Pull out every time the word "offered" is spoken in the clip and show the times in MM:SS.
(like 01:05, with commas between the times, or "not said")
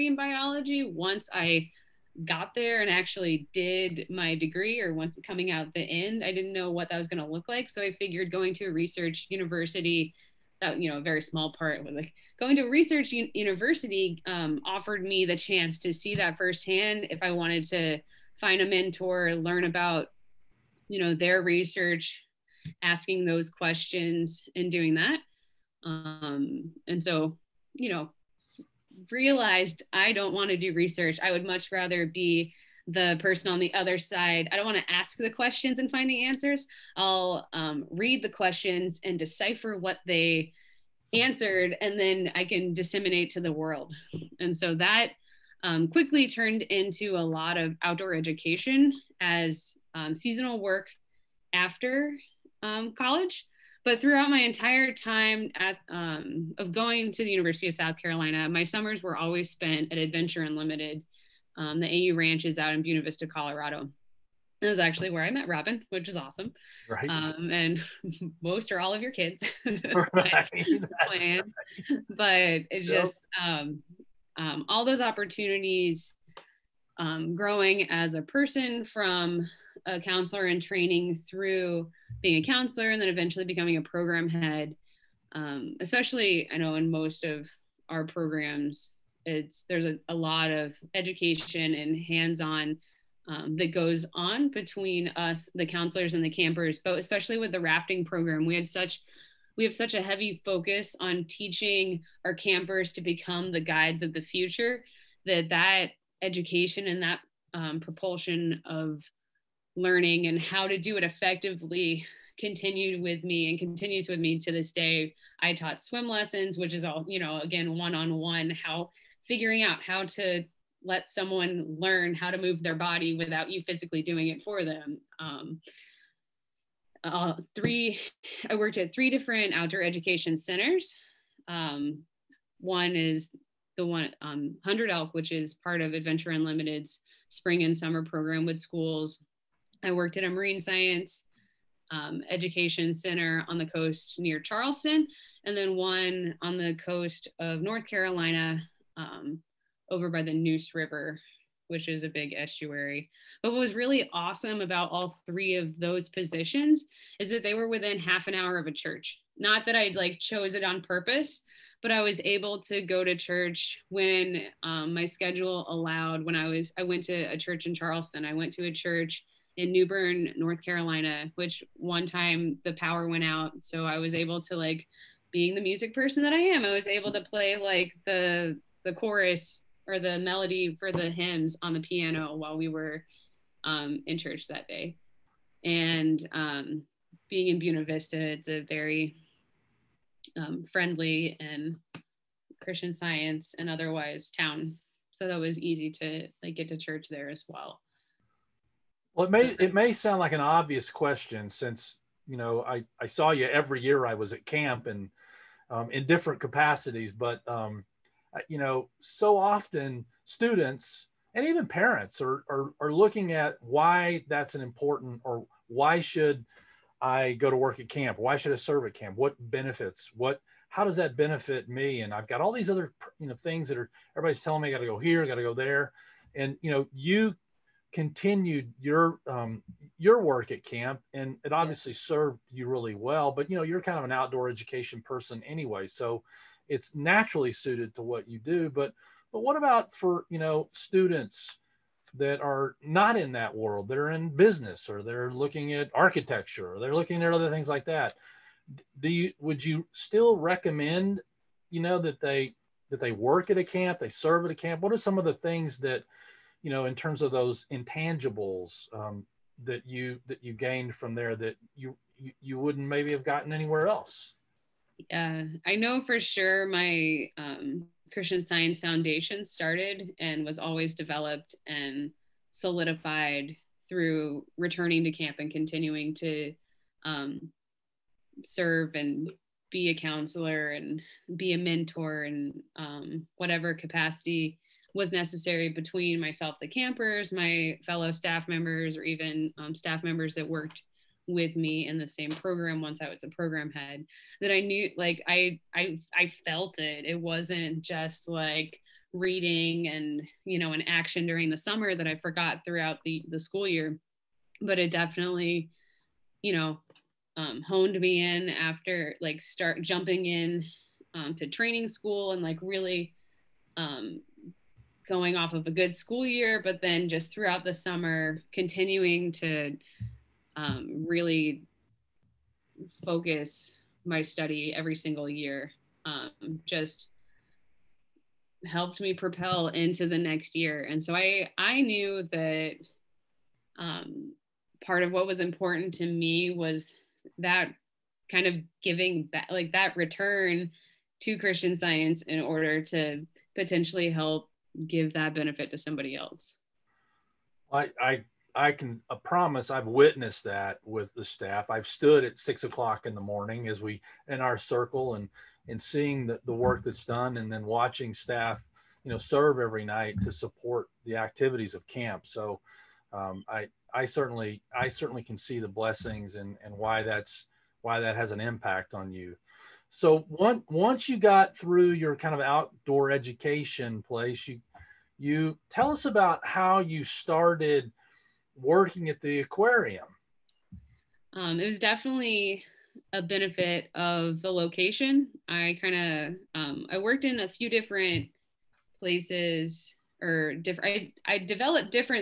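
00:14.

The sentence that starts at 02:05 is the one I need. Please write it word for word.
Um, uh, three, I worked at three different outdoor education centers.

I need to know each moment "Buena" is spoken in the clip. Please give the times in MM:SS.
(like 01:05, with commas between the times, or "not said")
01:02, 03:07.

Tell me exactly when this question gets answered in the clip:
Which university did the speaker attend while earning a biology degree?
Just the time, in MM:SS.
00:57.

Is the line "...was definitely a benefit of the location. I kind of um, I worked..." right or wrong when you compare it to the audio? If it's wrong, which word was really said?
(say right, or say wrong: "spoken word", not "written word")
right.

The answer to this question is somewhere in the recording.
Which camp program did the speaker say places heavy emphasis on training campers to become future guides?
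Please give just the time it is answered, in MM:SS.
01:37.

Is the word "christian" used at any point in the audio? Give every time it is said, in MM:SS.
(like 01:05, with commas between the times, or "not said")
03:12, 04:28, 05:41.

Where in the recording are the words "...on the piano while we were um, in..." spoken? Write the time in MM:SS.
03:01.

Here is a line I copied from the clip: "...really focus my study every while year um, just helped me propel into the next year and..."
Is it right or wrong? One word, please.
wrong.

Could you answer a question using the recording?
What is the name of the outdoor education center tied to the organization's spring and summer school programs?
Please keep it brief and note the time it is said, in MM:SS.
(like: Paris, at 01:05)
100 Elk, at 02:14.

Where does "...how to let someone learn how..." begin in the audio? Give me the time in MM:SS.
01:59.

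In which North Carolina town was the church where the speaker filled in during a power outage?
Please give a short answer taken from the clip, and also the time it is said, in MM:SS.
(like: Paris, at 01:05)
New Bern, at 02:49.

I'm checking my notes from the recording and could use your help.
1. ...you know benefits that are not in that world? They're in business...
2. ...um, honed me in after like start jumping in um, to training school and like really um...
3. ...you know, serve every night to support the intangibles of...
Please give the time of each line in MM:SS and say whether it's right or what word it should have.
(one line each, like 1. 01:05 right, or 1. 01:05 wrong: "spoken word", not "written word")
1. 04:00 wrong: "students", not "benefits"
2. 05:07 right
3. 05:59 wrong: "activities", not "intangibles".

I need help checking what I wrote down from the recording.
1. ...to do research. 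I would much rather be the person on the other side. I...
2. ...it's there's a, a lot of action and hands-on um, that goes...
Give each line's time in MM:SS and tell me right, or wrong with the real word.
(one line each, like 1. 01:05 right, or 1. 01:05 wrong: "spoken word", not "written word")
1. 00:30 right
2. 01:29 wrong: "education", not "action".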